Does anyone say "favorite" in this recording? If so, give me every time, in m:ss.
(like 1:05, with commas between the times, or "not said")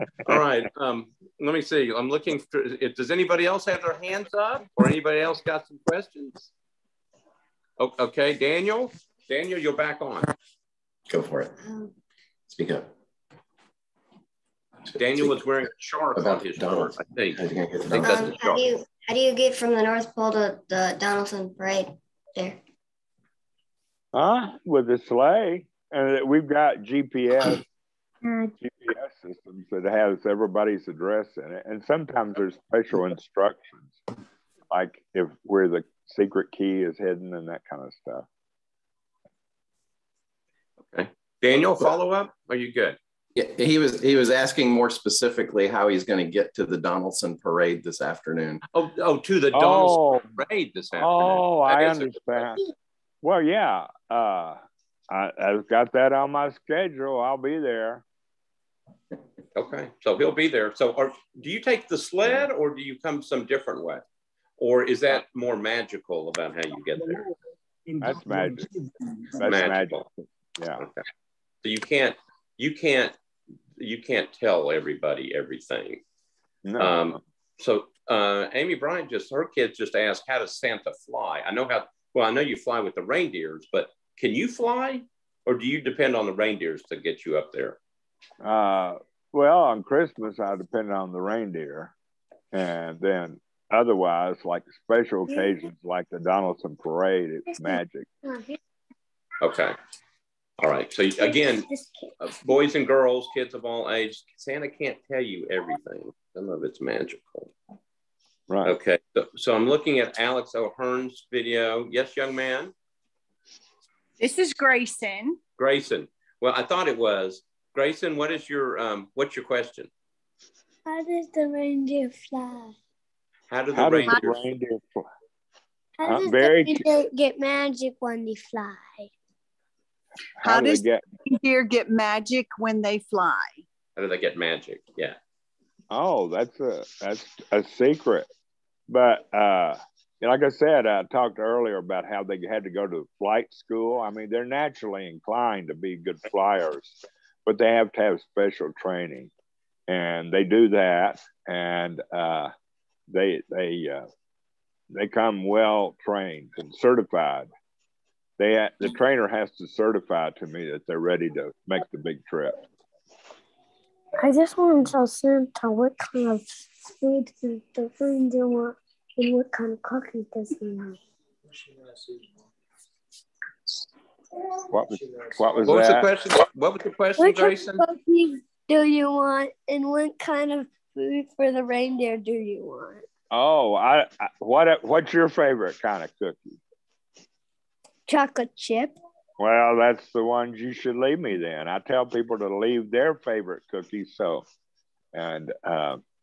3:05, 3:13.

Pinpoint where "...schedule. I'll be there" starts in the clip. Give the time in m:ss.
0:56.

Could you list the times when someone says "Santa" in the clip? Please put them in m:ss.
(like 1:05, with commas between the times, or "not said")
1:20, 1:44, 2:45.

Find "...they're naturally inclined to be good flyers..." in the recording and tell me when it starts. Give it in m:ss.
2:24.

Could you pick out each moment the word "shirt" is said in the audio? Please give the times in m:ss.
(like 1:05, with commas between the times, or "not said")
0:16.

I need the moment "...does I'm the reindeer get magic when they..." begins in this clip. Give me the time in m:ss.
2:06.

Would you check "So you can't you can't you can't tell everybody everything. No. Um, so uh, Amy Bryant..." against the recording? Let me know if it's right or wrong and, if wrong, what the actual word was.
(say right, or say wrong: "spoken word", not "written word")
right.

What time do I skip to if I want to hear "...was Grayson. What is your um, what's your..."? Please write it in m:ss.
1:56.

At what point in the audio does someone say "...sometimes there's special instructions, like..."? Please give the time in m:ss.
0:31.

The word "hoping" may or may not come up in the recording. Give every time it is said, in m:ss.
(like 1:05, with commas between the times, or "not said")
not said.